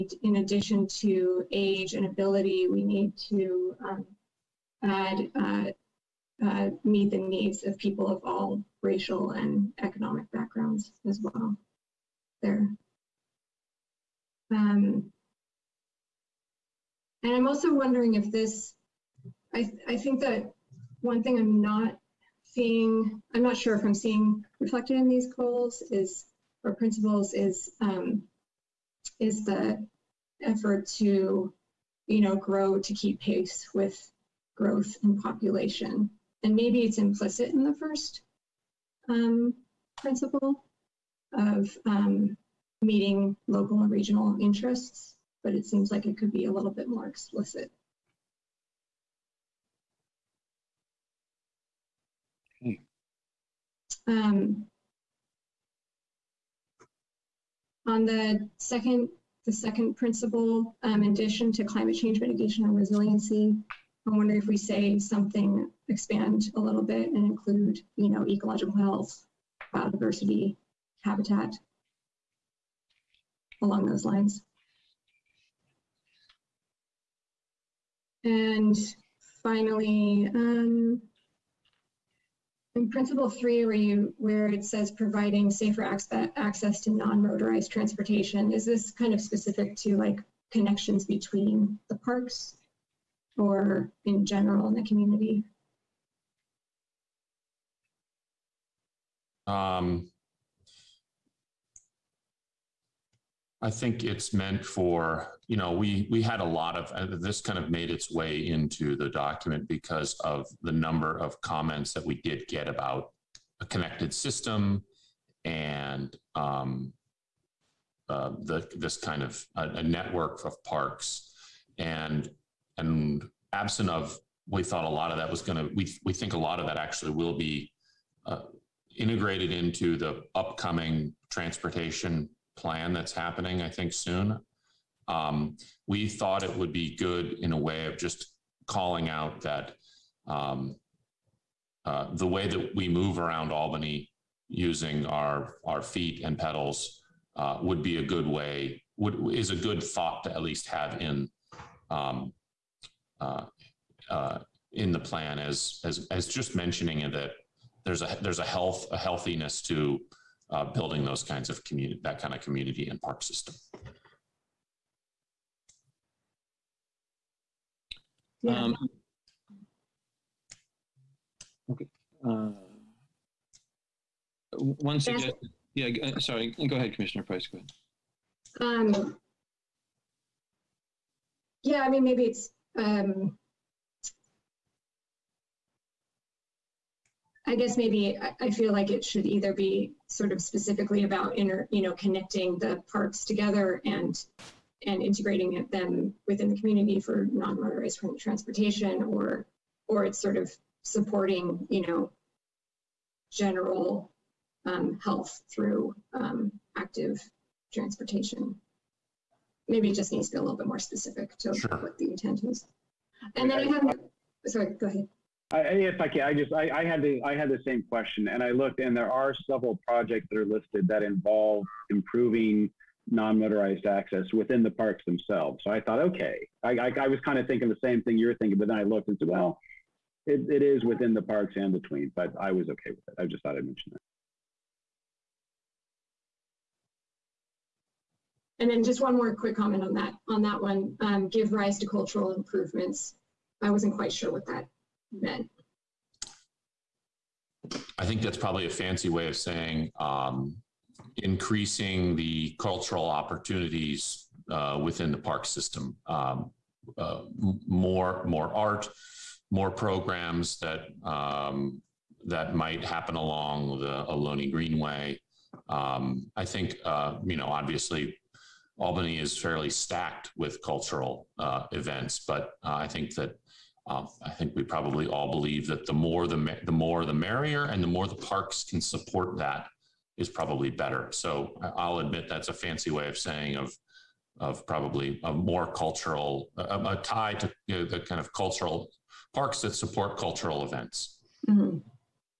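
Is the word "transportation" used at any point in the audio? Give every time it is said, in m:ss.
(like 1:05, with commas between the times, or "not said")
1:27, 2:11, 3:18, 3:27.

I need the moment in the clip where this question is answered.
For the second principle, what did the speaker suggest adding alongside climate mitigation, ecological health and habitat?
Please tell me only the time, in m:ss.
1:09.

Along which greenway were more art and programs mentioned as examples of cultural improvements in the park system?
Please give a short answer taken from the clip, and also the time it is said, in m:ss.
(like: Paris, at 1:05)
Ohlone Greenway, at 4:24.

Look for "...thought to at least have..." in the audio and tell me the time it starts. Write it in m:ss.
2:29.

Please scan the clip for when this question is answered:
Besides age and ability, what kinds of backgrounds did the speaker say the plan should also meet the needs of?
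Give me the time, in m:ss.
0:08.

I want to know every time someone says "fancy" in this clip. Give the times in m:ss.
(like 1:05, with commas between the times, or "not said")
4:08, 4:42.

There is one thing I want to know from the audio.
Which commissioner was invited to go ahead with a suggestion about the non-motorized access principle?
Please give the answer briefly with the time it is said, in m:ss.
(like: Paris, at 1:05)
Commissioner Price, at 2:56.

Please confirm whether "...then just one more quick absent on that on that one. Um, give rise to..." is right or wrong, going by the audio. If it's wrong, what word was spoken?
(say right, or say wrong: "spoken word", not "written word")
wrong: "comment", not "absent".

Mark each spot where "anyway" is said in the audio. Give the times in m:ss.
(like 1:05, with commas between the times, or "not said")
not said.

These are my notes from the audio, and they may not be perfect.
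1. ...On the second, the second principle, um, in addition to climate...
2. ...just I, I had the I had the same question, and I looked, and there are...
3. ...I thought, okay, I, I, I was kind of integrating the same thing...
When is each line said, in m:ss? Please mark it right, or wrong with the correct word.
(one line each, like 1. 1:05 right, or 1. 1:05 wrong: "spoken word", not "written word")
1. 0:57 right
2. 3:36 right
3. 3:45 wrong: "thinking", not "integrating".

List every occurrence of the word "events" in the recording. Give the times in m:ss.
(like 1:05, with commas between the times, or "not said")
4:31, 4:50.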